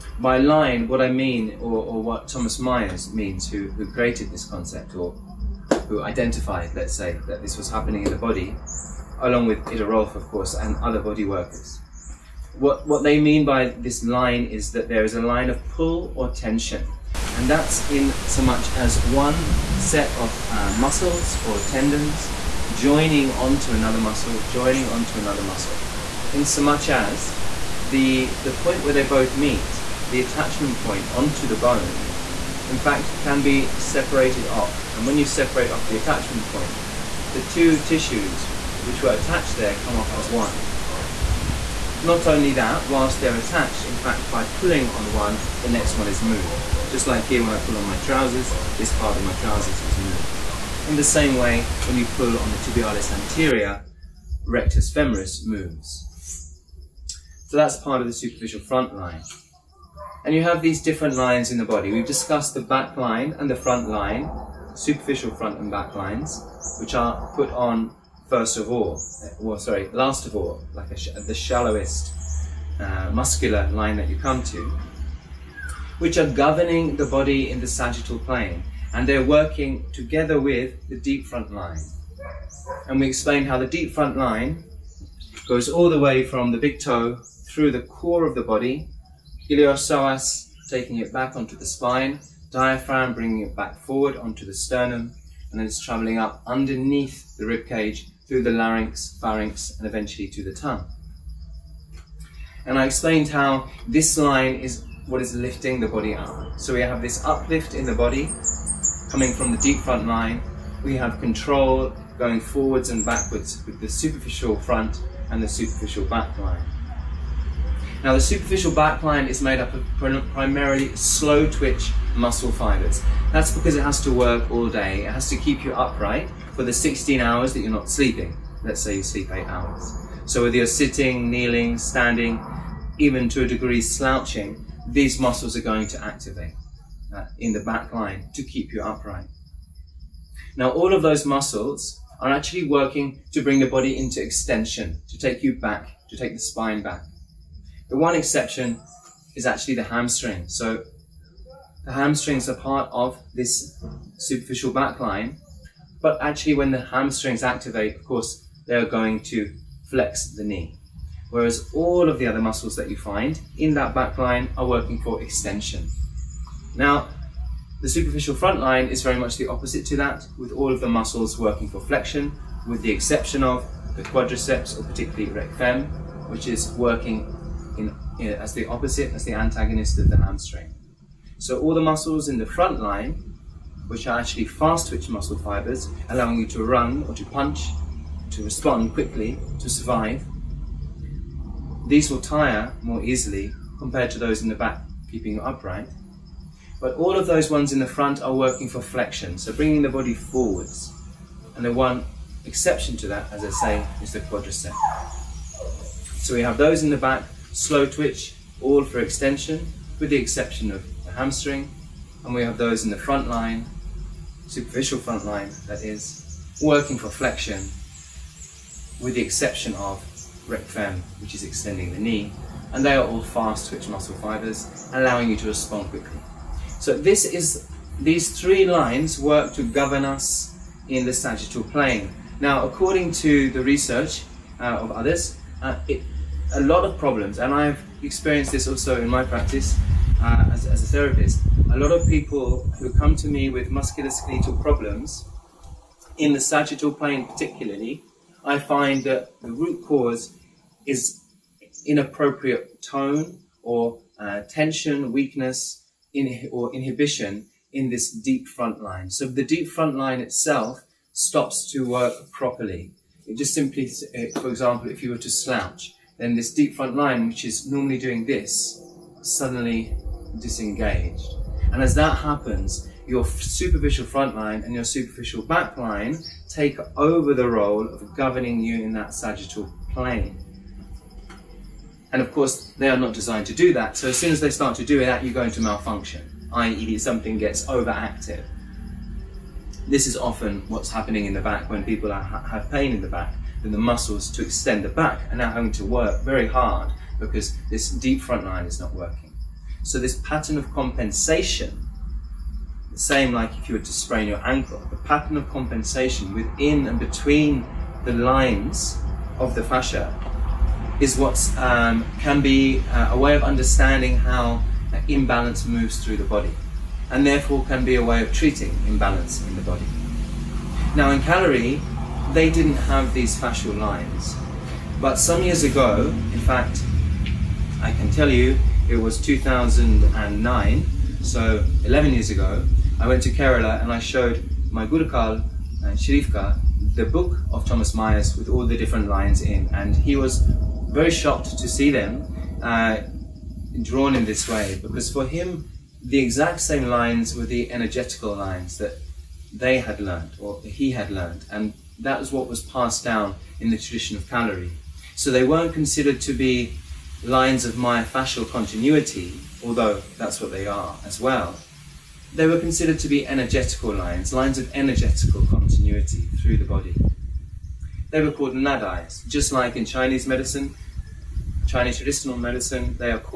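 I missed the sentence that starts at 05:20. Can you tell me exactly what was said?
Now in Kalari, they didn't have these fascial lines.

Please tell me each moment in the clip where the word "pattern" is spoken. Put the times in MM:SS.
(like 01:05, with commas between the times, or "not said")
05:00, 05:04.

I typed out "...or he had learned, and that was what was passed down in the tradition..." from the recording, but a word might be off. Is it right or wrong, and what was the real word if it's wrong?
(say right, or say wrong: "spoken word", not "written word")
right.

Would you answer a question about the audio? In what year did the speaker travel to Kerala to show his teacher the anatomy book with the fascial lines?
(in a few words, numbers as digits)
2009.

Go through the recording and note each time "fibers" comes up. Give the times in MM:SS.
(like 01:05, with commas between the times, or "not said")
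02:02, 03:05, 03:44.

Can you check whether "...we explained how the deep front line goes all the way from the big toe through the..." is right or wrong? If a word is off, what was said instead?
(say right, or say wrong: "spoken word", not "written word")
right.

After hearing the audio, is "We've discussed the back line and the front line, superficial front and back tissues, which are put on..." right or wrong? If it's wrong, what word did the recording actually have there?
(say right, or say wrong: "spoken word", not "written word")
wrong: "lines", not "tissues".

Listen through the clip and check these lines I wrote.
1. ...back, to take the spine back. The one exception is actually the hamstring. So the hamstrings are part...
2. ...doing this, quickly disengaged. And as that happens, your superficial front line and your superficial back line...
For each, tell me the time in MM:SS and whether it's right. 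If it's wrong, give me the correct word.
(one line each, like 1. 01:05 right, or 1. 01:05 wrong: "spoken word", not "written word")
1. 02:25 right
2. 04:27 wrong: "suddenly", not "quickly".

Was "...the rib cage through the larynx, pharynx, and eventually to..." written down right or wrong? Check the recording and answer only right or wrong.
right.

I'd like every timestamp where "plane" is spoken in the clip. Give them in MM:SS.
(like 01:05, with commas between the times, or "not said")
01:18, 03:51, 04:06, 04:39.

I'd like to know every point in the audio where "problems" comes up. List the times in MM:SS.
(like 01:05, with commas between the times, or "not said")
03:56, 04:04.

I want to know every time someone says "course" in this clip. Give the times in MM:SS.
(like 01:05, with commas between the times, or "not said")
00:10, 02:38, 04:42.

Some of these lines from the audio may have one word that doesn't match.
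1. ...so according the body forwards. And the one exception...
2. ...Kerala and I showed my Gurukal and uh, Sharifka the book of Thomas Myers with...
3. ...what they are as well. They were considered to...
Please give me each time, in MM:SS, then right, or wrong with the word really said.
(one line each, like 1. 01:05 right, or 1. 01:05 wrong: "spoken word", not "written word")
1. 03:19 wrong: "bringing", not "according"
2. 05:33 right
3. 06:00 right.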